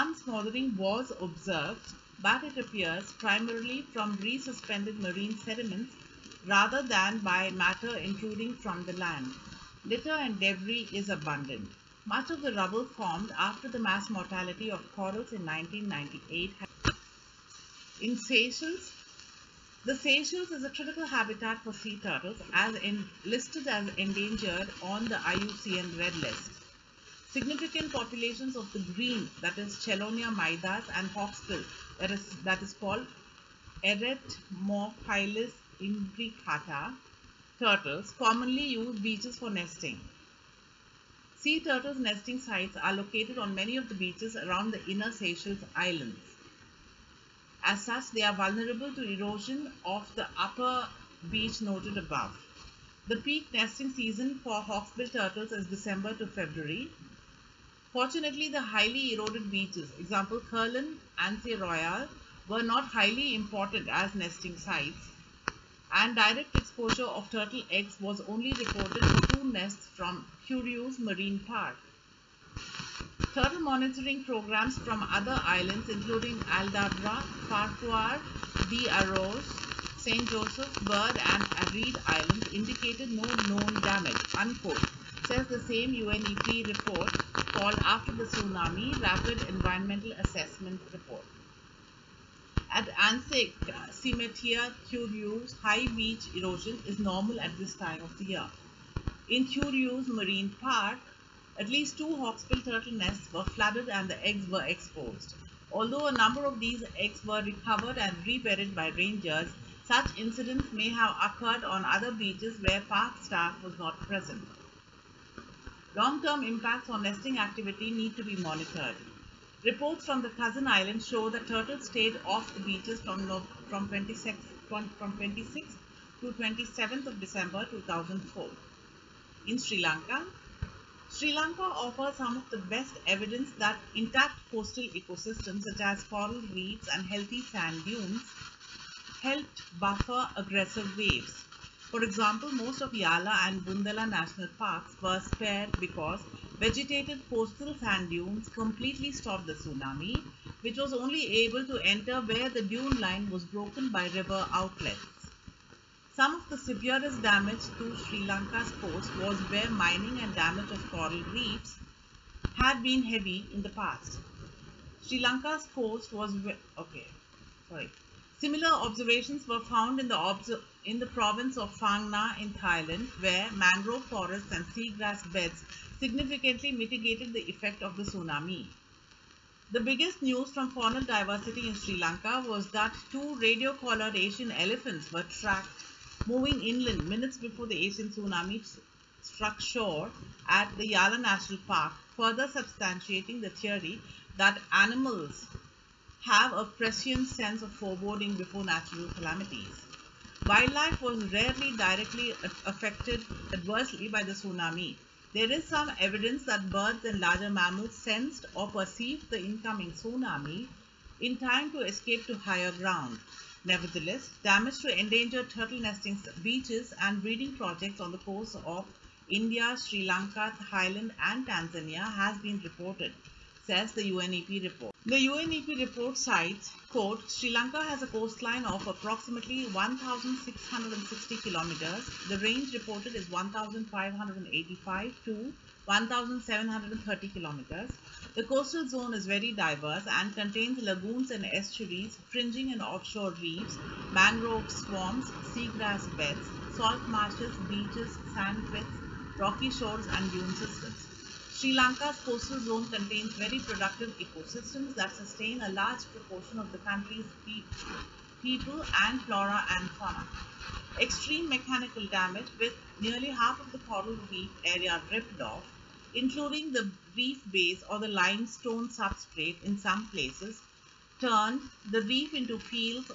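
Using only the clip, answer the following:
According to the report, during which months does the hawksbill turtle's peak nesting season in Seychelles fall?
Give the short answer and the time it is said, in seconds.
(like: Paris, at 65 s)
December to February, at 55 s.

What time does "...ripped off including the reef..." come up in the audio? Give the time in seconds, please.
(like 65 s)
265 s.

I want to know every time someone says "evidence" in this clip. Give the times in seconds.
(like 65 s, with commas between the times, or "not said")
133 s, 205 s.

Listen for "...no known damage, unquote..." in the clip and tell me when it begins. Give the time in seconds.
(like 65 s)
83 s.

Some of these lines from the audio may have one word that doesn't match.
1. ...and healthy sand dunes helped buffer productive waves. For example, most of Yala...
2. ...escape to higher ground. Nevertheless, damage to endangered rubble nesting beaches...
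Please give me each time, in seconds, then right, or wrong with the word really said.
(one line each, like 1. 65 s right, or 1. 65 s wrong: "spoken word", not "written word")
1. 136 s wrong: "aggressive", not "productive"
2. 211 s wrong: "turtle", not "rubble".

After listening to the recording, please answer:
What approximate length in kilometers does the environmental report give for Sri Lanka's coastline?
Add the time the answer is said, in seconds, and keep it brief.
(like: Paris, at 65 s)
1,660 kilometers, at 229 s.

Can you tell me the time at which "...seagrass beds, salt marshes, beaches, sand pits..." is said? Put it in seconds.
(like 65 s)
245 s.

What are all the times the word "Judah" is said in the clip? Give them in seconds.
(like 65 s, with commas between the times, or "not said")
not said.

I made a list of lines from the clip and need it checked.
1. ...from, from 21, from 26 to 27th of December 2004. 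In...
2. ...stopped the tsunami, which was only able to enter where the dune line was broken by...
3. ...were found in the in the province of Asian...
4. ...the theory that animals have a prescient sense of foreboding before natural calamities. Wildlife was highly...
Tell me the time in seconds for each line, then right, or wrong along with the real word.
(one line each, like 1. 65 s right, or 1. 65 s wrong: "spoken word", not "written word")
1. 123 s wrong: "26", not "21"
2. 149 s right
3. 169 s wrong: "Phang", not "Asian"
4. 193 s wrong: "rarely", not "highly".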